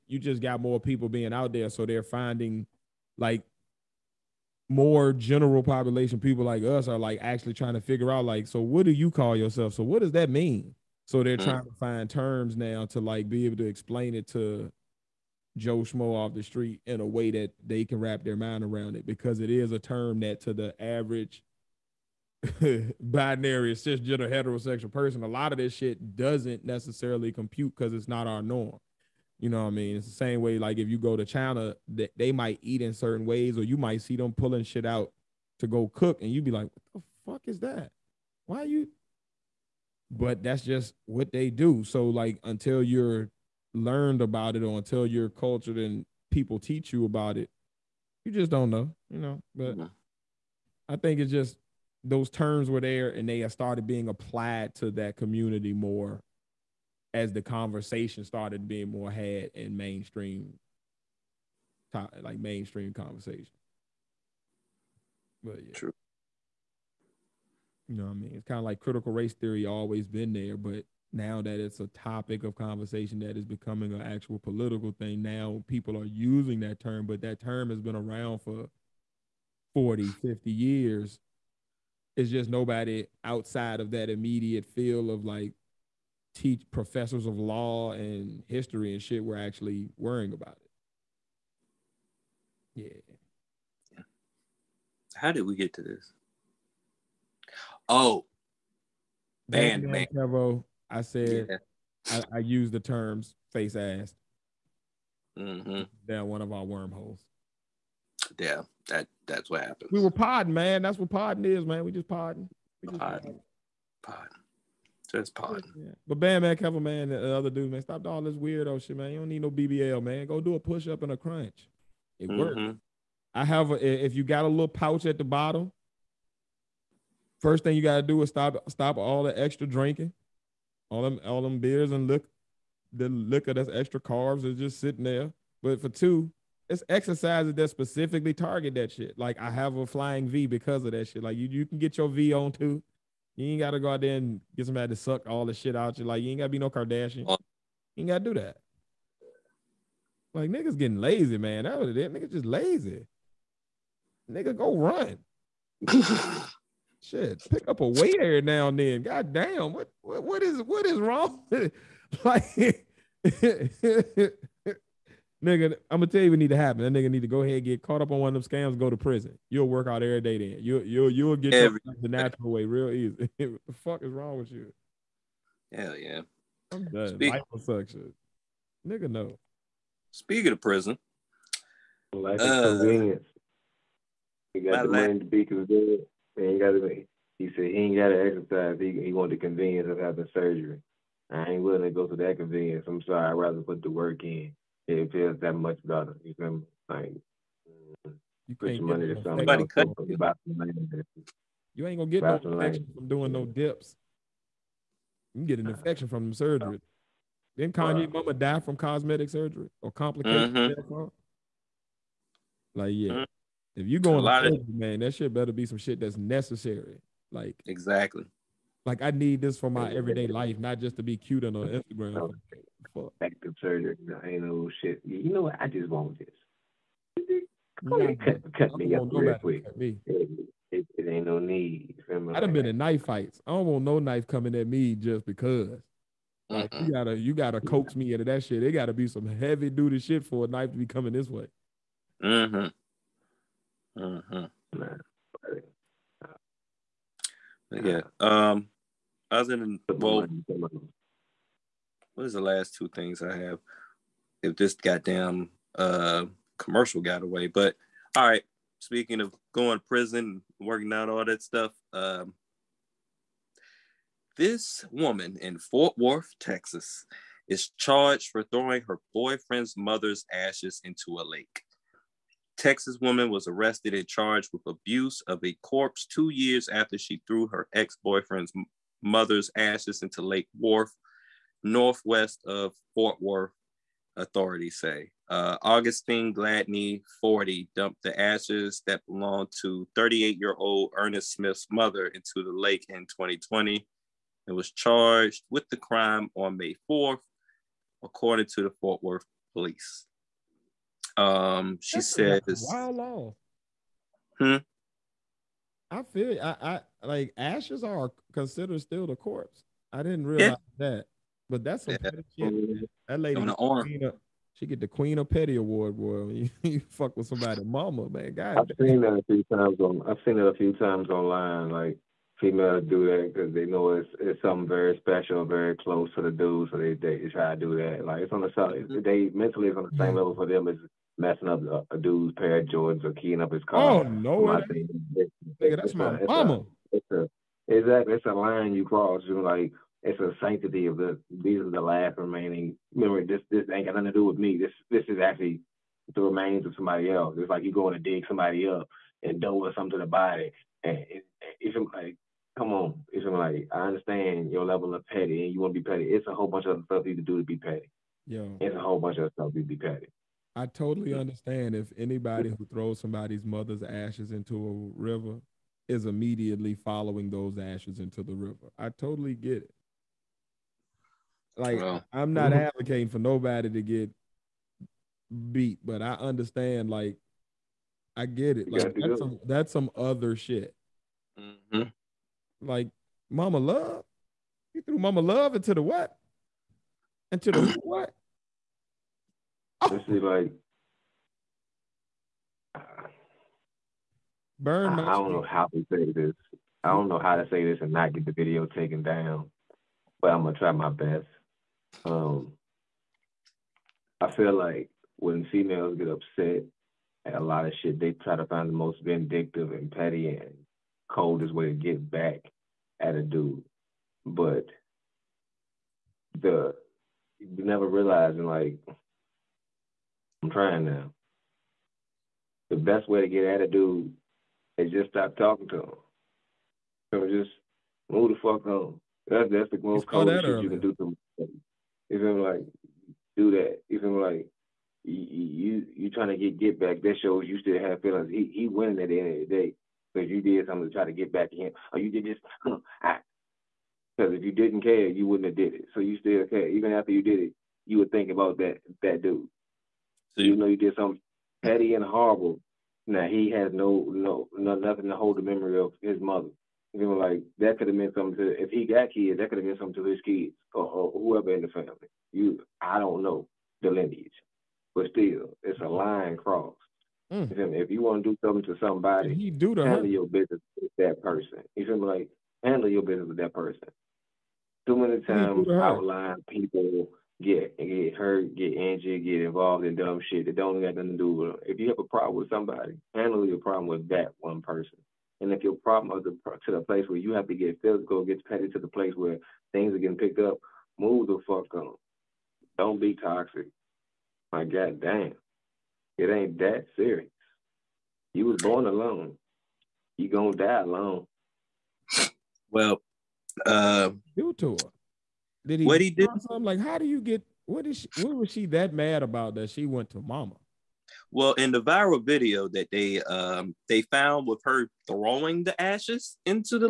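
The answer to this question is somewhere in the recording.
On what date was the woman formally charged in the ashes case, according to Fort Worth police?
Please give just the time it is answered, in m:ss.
4:56.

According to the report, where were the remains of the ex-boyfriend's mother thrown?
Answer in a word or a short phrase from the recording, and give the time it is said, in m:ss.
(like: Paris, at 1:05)
Lake Worth, at 4:40.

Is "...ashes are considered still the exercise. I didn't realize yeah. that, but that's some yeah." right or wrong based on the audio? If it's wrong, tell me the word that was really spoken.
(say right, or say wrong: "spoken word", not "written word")
wrong: "corpse", not "exercise".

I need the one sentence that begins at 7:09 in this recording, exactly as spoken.
That's that's the most cold shit earlier.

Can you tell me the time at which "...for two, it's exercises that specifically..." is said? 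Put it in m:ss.
2:15.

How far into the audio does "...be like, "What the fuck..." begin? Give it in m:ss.
0:36.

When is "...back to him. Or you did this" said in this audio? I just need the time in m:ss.
7:21.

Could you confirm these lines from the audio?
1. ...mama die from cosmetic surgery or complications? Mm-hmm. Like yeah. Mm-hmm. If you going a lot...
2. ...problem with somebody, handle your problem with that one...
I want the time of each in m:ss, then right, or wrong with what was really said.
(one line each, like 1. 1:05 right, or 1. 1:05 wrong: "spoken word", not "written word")
1. 3:28 right
2. 8:02 right.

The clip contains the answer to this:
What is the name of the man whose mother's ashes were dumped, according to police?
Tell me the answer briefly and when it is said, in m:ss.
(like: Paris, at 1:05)
Ernest Smith, at 4:50.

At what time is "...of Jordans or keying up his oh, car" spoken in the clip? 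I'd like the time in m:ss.
5:32.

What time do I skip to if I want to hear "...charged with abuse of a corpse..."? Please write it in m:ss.
4:34.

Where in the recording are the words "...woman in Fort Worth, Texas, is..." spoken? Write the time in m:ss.
4:24.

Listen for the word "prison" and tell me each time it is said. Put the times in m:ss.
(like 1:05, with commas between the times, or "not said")
2:48, 3:00, 4:19.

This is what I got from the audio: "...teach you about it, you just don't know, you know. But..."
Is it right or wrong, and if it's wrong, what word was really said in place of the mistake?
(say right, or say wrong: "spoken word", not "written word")
right.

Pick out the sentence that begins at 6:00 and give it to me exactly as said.
I totally understand if anybody who throws somebody's mother's ashes into a river is immediately following those ashes into the river.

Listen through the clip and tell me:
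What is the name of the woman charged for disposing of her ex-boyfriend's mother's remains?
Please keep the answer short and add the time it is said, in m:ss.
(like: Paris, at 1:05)
Augustine Gladney, at 4:45.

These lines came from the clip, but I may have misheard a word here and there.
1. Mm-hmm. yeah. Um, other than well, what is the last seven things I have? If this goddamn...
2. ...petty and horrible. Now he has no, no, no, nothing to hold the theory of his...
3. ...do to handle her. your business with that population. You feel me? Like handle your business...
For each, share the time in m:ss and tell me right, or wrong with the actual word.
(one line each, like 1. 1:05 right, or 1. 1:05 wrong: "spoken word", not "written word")
1. 4:03 wrong: "two", not "seven"
2. 7:31 wrong: "memory", not "theory"
3. 7:49 wrong: "person", not "population".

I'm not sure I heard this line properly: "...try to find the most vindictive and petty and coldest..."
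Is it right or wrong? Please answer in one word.
right.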